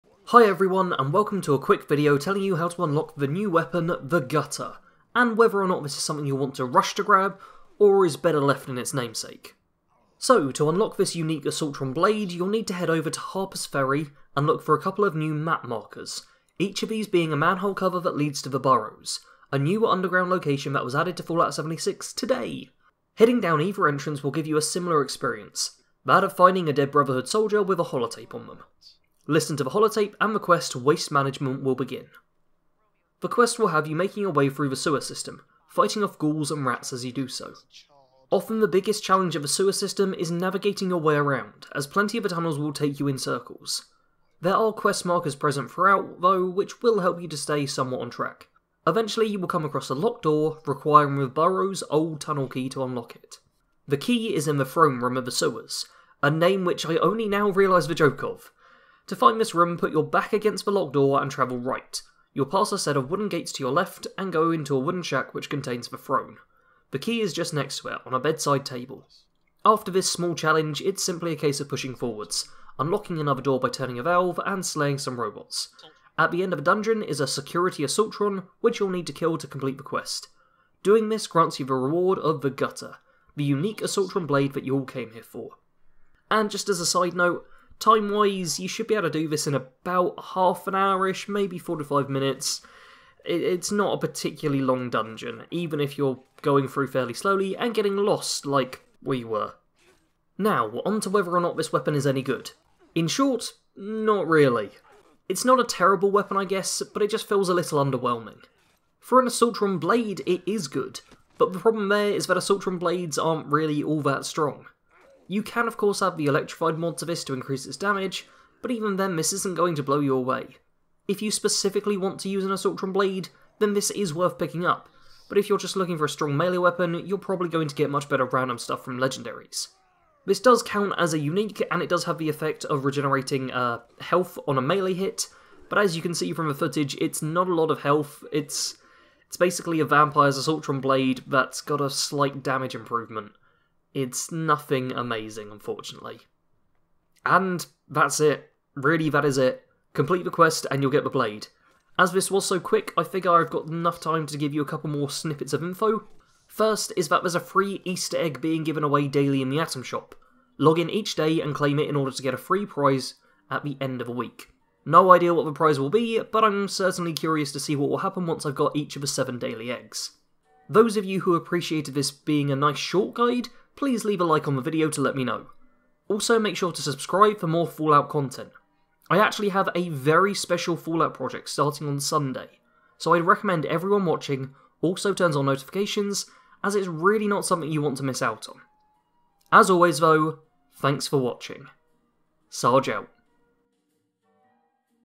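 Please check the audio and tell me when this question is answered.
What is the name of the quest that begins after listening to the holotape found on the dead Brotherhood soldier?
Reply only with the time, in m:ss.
0:30.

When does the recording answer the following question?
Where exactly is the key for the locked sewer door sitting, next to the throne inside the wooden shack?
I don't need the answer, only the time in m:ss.
1:08.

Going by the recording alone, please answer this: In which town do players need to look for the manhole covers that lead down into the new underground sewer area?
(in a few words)
Harper's Ferry.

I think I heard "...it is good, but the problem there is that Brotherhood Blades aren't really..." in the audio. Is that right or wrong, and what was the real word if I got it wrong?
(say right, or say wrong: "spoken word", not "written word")
wrong: "Assaultron", not "Brotherhood".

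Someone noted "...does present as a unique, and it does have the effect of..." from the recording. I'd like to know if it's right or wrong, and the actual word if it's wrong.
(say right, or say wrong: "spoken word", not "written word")
wrong: "count", not "present".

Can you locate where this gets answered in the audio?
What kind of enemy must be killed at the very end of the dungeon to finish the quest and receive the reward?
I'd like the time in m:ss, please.
1:17.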